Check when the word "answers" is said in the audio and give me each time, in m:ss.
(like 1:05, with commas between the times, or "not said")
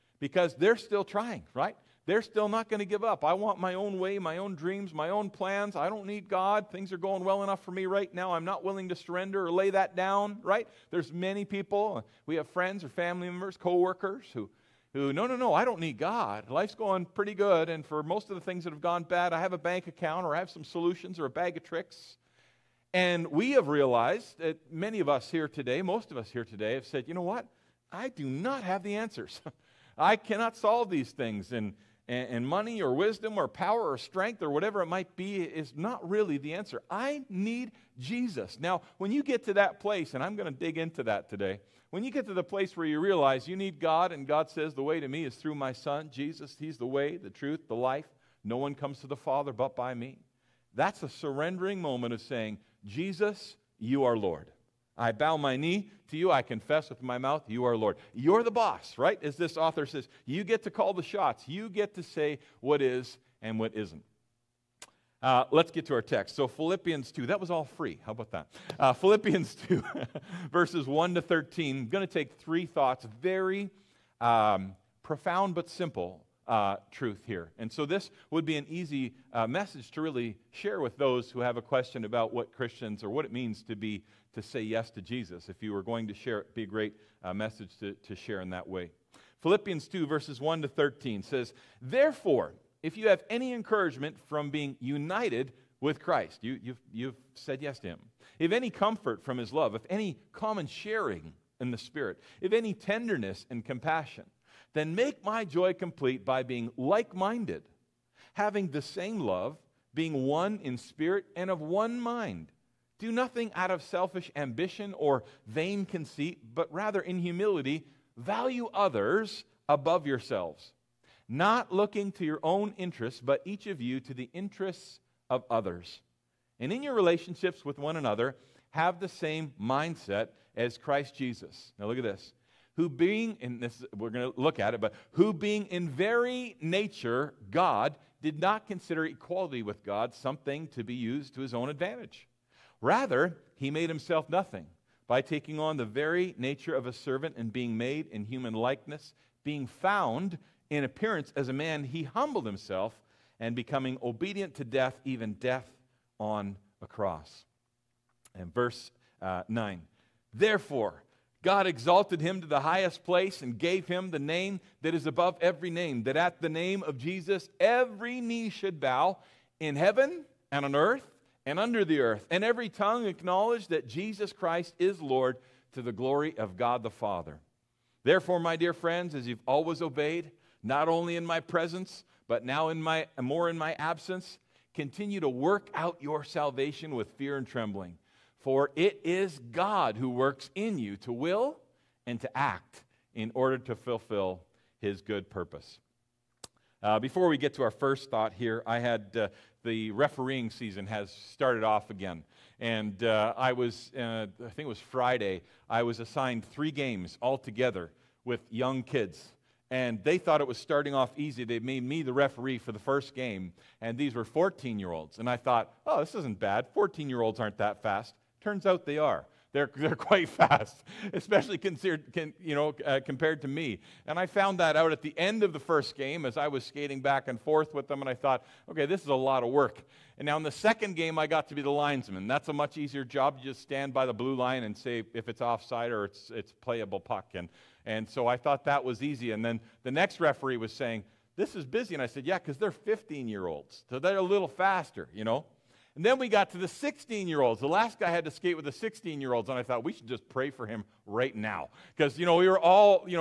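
0:28, 0:36.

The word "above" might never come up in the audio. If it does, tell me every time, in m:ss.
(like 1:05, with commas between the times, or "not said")
1:59, 2:45.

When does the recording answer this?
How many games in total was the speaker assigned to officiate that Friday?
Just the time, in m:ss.
3:26.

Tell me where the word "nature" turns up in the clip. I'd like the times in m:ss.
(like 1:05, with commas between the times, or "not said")
2:16, 2:26.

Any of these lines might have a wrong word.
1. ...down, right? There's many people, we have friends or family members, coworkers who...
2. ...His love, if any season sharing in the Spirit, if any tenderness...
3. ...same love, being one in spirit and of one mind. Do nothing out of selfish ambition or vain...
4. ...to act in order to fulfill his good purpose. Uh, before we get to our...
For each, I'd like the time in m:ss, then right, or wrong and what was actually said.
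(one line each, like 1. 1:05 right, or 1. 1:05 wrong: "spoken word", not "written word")
1. 0:09 right
2. 1:39 wrong: "common", not "season"
3. 1:48 right
4. 3:12 right.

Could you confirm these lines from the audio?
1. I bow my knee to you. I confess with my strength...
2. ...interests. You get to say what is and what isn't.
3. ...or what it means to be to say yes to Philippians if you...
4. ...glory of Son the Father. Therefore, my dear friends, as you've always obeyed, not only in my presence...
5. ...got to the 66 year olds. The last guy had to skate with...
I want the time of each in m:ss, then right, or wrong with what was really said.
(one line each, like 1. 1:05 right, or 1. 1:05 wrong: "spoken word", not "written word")
1. 0:54 wrong: "mouth", not "strength"
2. 1:01 wrong: "shots", not "interests"
3. 1:23 wrong: "Jesus", not "Philippians"
4. 2:55 wrong: "God", not "Son"
5. 4:06 wrong: "16", not "66".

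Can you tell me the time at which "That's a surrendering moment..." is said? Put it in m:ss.
0:50.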